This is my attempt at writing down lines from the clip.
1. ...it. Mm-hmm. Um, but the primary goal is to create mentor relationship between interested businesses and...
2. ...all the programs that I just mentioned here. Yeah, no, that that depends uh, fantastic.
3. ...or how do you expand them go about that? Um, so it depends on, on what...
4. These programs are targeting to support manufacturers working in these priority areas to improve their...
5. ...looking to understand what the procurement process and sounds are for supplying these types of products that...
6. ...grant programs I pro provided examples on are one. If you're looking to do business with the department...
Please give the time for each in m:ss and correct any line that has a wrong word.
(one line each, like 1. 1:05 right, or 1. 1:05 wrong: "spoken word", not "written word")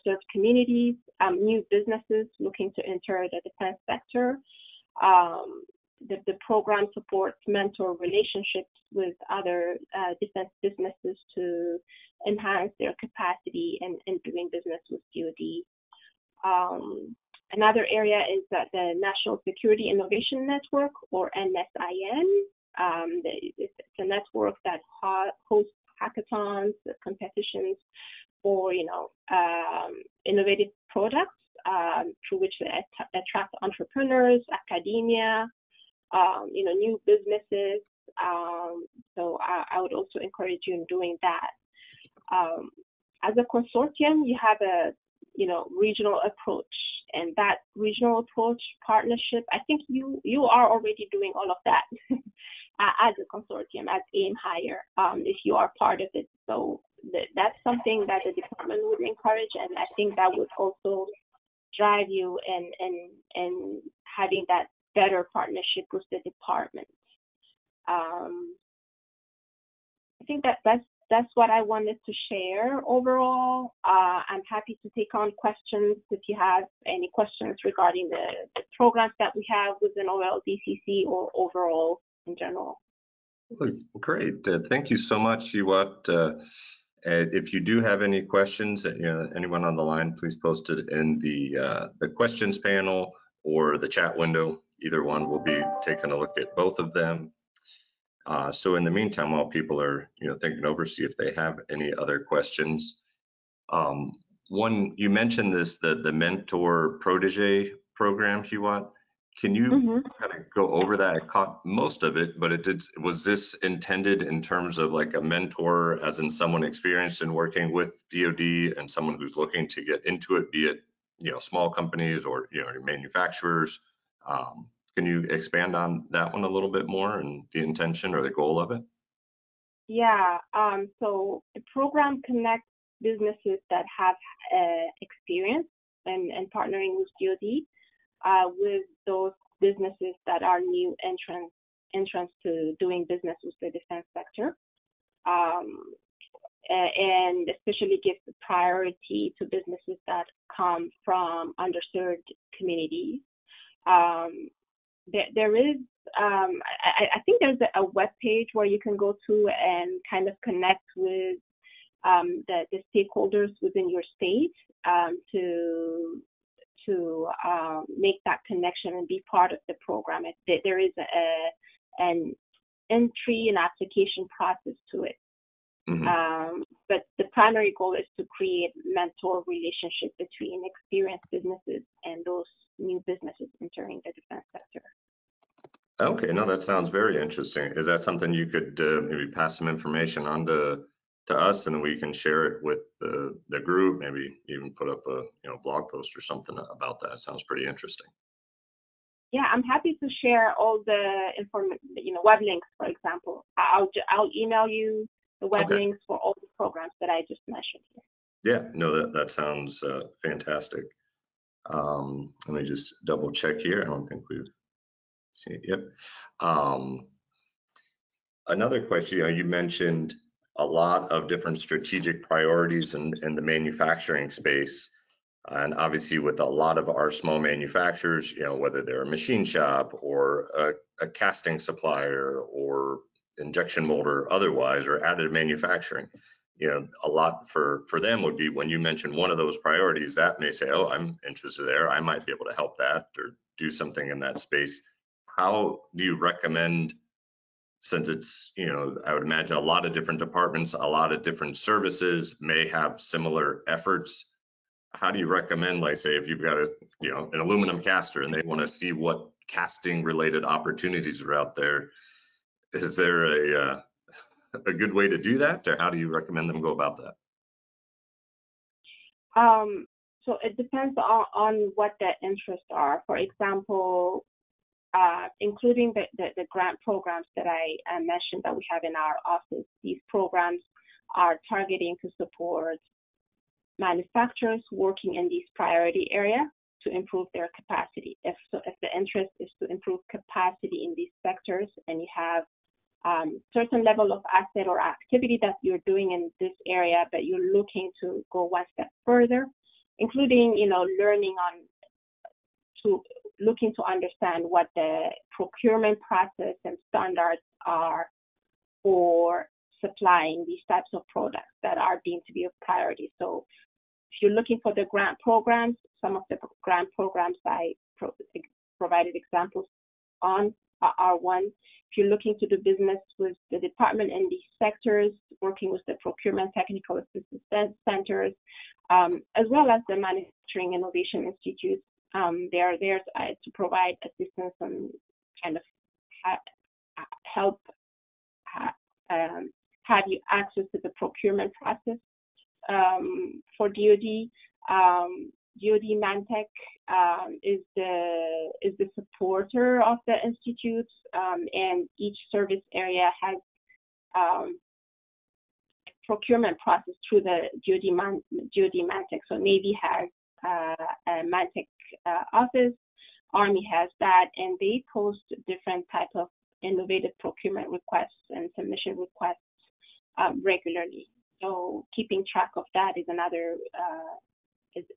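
1. 2:55 wrong: "experienced", not "interested"
2. 3:26 wrong: "sounds", not "depends"
3. 4:25 wrong: "recommend", not "expand"
4. 4:39 right
5. 5:03 wrong: "standards", not "sounds"
6. 5:16 right.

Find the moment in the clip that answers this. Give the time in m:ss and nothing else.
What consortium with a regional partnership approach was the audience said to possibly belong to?
0:54.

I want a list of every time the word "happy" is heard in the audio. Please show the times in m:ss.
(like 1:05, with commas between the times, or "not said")
1:14, 3:19.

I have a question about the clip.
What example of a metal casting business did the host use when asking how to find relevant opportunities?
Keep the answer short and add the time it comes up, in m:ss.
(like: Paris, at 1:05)
aluminum caster, at 4:17.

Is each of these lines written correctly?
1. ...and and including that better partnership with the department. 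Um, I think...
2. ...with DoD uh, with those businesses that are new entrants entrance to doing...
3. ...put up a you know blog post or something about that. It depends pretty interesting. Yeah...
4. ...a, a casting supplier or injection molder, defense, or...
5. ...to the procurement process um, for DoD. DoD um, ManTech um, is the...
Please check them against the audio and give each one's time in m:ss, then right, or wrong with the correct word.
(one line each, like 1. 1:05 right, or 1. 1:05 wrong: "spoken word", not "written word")
1. 1:02 wrong: "having", not "including"
2. 2:16 right
3. 3:14 wrong: "sounds", not "depends"
4. 3:50 wrong: "otherwise", not "defense"
5. 5:40 right.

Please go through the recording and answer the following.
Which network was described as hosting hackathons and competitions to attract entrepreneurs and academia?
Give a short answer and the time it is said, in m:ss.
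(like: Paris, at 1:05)
National Security Innovation Network, at 0:18.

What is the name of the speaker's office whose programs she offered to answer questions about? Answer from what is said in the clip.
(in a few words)
OLDCC.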